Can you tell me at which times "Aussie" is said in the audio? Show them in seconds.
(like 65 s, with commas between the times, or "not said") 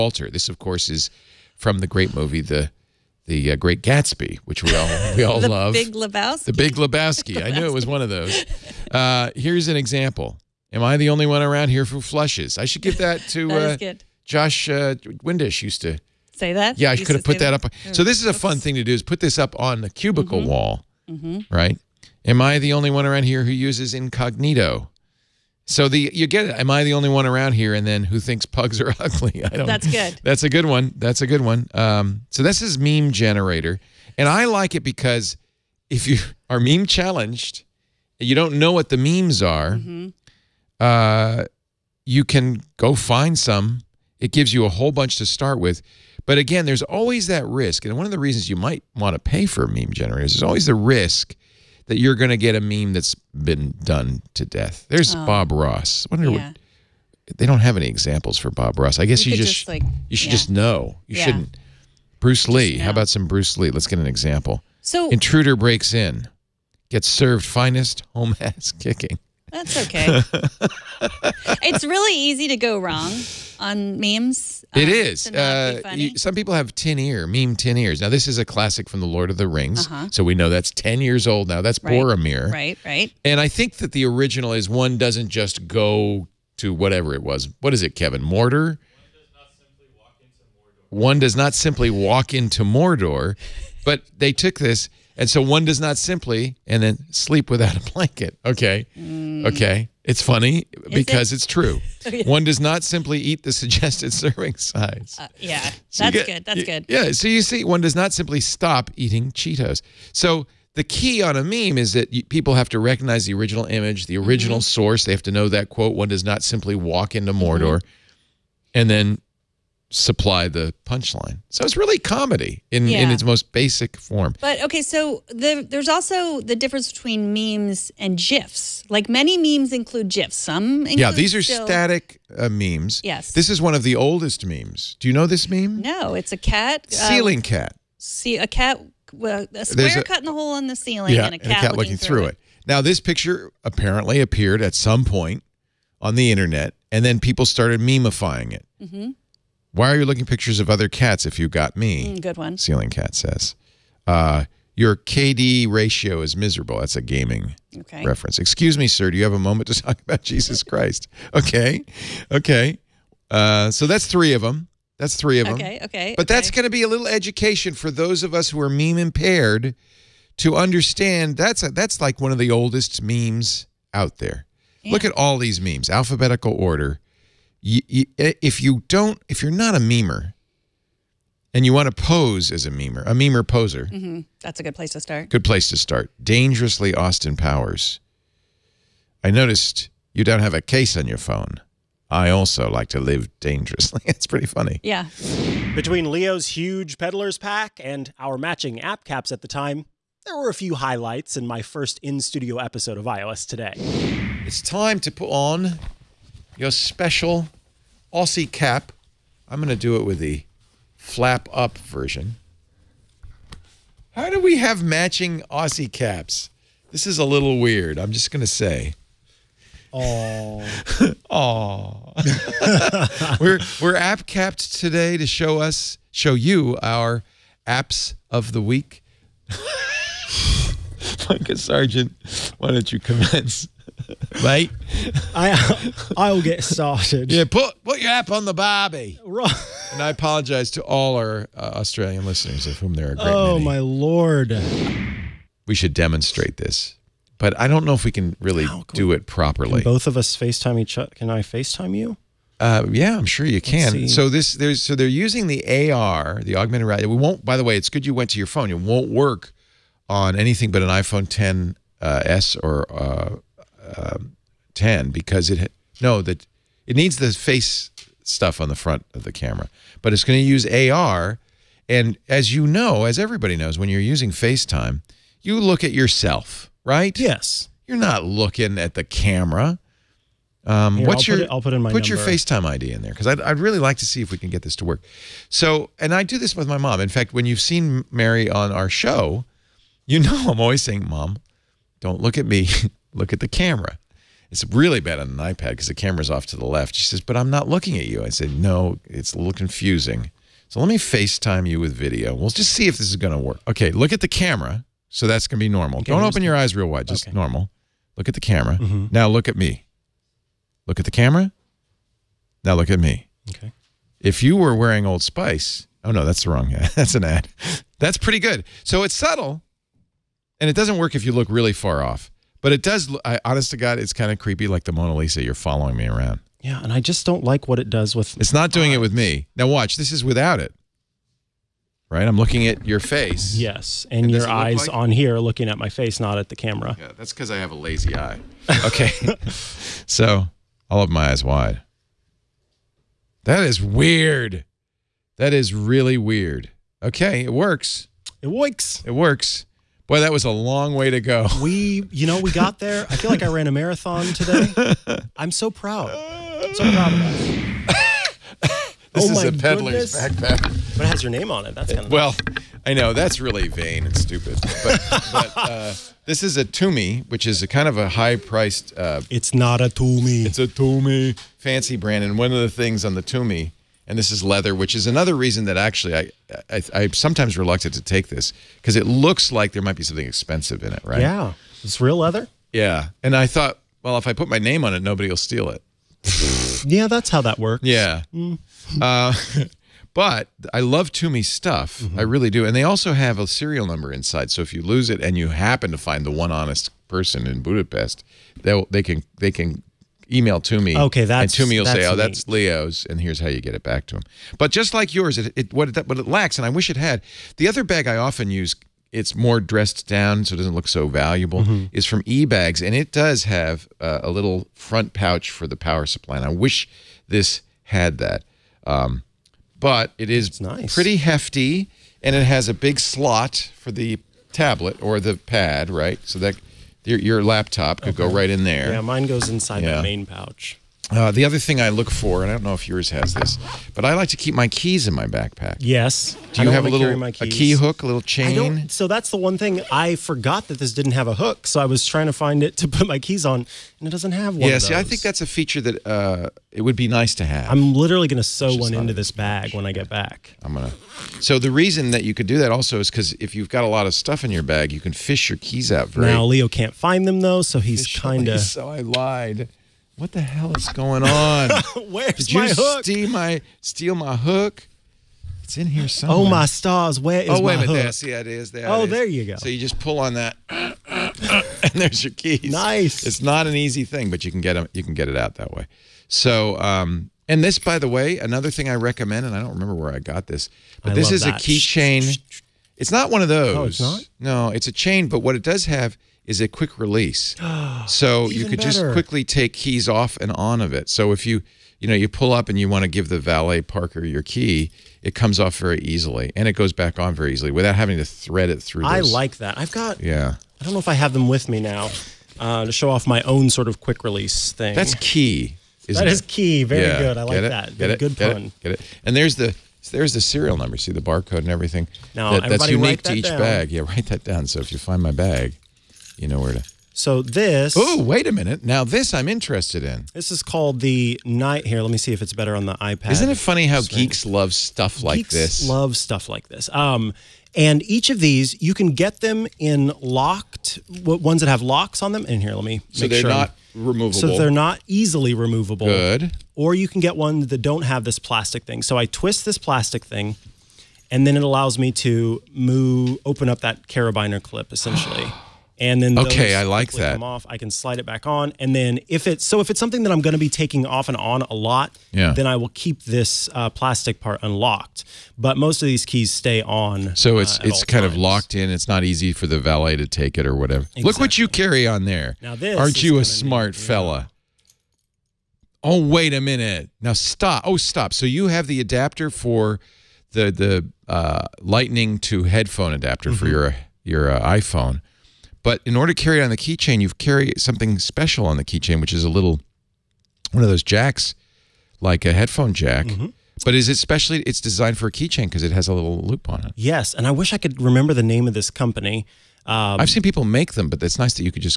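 208 s, 215 s.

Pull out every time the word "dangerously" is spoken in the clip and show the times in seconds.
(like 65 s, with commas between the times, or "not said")
186 s, 193 s.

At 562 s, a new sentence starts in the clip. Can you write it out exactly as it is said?
Now this aren't you a smart be, fella?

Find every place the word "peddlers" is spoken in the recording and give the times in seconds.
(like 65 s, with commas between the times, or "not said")
196 s, 359 s.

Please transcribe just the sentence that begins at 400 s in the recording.
Okay, that's and to me will say, "Oh, neat.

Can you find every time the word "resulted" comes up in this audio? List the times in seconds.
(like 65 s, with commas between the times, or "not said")
not said.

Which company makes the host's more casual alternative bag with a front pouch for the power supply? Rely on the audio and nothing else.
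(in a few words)
eBags.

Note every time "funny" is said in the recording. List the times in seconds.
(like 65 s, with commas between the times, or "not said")
100 s, 194 s, 523 s.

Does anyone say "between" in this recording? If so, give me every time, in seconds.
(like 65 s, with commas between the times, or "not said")
126 s, 195 s.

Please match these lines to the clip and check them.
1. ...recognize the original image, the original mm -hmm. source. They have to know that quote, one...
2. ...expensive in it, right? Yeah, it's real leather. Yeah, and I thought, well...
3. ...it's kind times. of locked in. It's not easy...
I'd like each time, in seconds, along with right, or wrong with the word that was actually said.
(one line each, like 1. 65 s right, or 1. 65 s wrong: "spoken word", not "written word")
1. 112 s right
2. 380 s right
3. 557 s right.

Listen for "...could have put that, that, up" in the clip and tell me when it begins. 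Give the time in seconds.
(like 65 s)
16 s.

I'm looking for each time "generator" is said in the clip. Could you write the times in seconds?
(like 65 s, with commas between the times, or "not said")
33 s, 49 s.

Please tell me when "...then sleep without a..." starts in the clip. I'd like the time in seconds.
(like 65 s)
96 s.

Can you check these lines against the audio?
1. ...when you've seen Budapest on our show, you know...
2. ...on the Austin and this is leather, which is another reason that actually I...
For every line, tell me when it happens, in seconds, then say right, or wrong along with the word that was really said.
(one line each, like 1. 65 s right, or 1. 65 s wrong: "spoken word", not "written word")
1. 287 s wrong: "Mary", not "Budapest"
2. 373 s wrong: "Tumi", not "Austin".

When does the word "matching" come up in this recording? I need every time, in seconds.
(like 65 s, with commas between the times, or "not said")
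198 s, 214 s.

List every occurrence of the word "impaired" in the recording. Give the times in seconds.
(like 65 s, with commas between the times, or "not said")
168 s.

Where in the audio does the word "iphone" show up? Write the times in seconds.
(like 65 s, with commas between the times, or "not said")
260 s, 574 s.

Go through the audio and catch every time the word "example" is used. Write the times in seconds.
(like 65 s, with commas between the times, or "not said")
9 s, 57 s, 64 s.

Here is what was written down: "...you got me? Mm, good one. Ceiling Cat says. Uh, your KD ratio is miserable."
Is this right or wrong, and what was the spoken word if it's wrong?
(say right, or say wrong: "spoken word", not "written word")
right.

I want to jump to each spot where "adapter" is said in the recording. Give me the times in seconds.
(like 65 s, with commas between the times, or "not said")
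568 s, 573 s.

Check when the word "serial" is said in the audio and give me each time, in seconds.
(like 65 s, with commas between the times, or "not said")
393 s, 510 s.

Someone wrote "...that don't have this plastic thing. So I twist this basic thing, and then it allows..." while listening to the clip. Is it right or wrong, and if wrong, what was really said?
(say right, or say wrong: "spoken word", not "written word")
wrong: "plastic", not "basic".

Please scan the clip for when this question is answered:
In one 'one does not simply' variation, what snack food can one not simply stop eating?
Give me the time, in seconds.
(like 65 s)
109 s.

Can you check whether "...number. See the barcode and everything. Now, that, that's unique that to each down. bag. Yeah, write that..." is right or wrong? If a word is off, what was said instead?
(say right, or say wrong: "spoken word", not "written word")
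right.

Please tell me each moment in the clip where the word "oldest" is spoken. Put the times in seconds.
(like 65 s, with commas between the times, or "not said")
133 s, 172 s.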